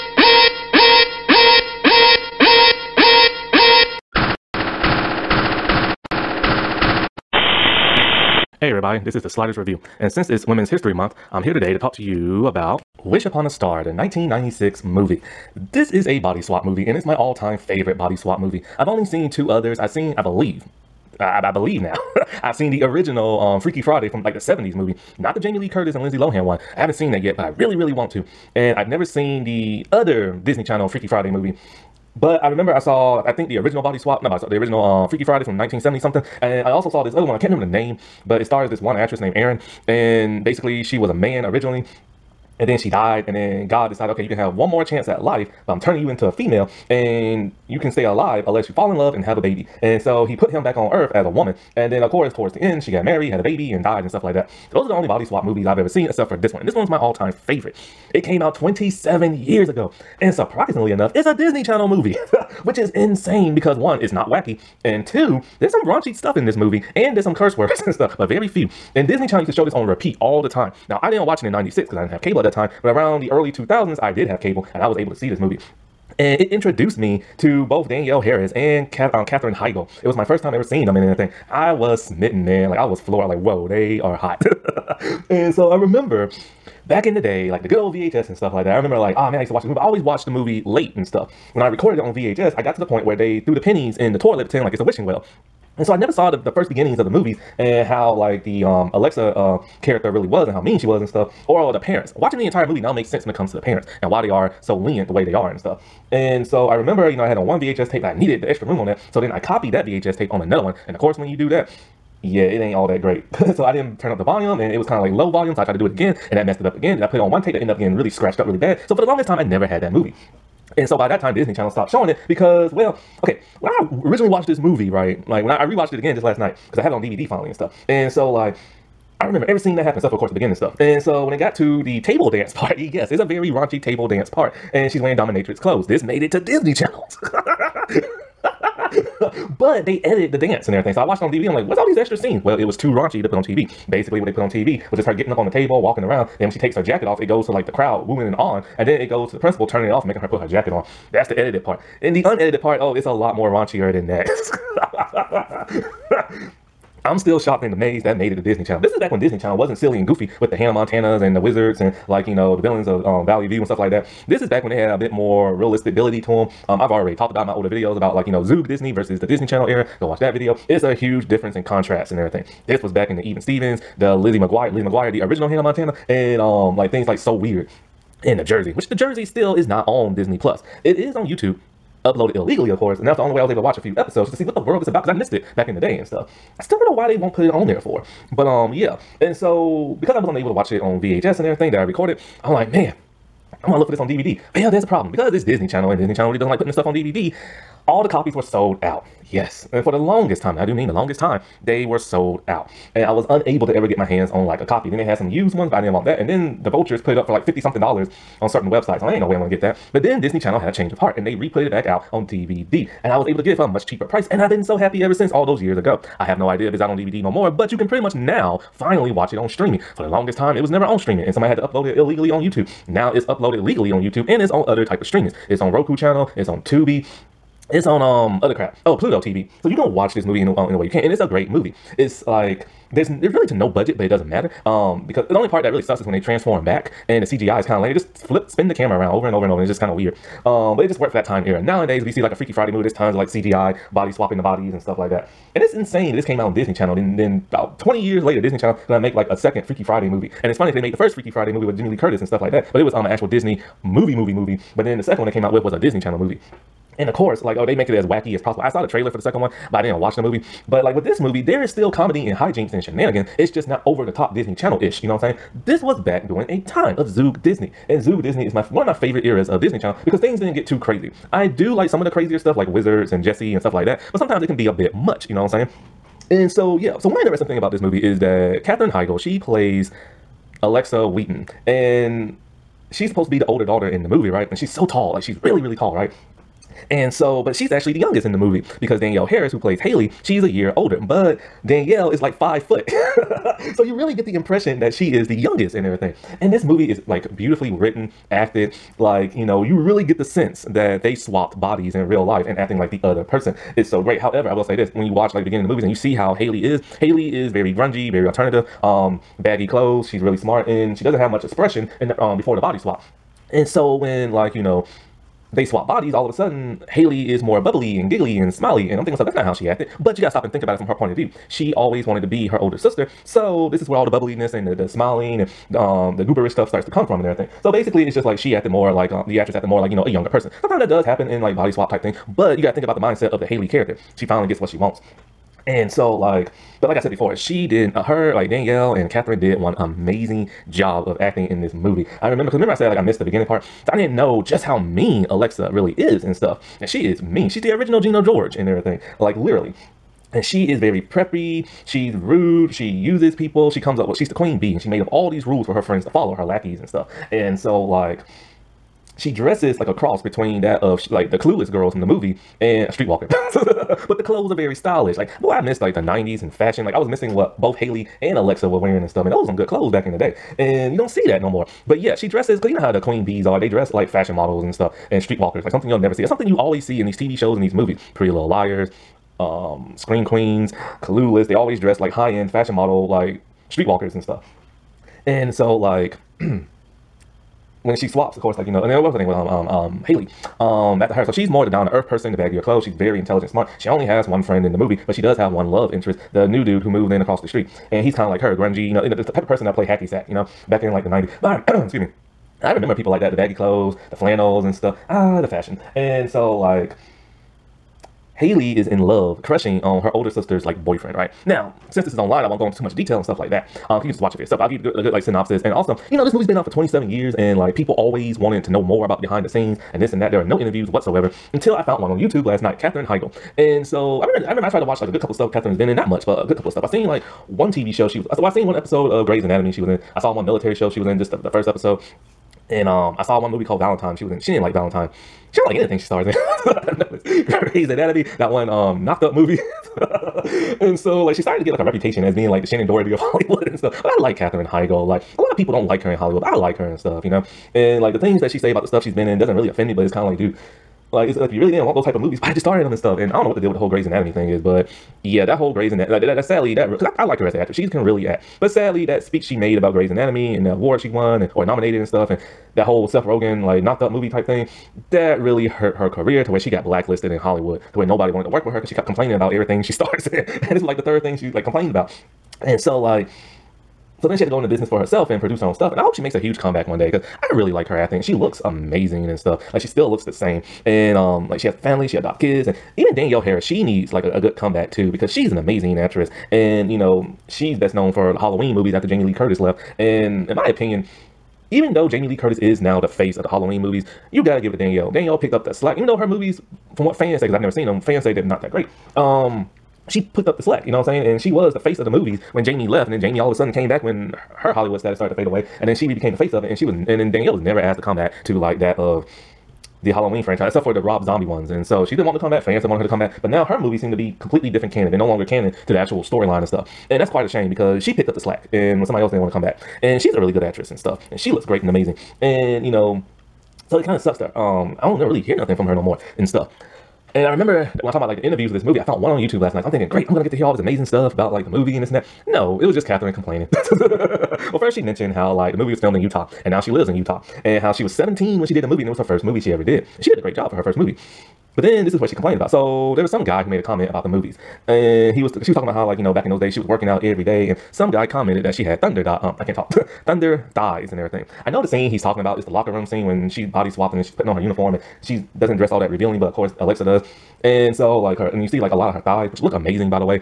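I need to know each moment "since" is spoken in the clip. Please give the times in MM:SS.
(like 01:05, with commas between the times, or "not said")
00:10, 03:35, 06:51.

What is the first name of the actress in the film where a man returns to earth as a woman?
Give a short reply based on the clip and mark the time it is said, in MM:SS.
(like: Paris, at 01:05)
Erin, at 00:39.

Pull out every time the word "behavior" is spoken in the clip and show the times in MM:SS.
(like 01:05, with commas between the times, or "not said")
not said.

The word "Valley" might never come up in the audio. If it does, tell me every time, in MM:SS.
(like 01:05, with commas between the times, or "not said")
02:43.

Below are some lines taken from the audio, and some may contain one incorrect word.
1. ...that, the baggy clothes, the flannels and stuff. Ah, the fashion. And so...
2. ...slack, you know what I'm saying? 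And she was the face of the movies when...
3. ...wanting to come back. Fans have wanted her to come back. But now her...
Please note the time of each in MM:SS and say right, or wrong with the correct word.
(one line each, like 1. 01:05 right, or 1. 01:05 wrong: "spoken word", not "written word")
1. 06:43 right
2. 08:20 right
3. 08:32 right.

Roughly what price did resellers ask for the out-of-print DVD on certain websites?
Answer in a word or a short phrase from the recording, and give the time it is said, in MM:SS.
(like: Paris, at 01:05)
50 something dollars, at 03:27.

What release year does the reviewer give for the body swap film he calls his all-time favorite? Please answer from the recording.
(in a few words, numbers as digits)
1996.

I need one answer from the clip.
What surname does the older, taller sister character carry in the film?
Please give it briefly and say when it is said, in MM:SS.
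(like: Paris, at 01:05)
Wheaton, at 04:40.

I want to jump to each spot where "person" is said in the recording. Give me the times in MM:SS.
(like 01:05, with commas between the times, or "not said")
05:03, 05:30, 06:32, 06:39.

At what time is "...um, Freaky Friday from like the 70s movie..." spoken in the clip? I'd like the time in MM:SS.
00:23.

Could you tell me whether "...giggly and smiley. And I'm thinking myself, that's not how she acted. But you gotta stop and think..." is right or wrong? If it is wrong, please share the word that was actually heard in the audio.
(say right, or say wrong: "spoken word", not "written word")
right.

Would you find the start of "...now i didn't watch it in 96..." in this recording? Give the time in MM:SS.
01:10.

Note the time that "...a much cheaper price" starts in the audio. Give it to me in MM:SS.
03:33.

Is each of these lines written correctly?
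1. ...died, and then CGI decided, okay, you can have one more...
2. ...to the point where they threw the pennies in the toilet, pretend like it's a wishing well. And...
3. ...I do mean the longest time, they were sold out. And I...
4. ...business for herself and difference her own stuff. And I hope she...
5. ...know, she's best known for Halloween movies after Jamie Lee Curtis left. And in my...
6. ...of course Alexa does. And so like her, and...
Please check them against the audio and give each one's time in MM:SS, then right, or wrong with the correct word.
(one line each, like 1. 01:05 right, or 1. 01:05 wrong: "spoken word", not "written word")
1. 00:42 wrong: "God", not "CGI"
2. 01:32 right
3. 03:20 right
4. 07:54 wrong: "produce", not "difference"
5. 08:06 right
6. 09:16 right.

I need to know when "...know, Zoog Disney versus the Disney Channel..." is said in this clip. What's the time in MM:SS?
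02:48.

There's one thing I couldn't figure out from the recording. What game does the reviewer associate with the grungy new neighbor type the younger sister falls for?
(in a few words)
hacky sack.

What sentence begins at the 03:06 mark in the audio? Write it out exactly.
I still don't know why they won't put it on there for.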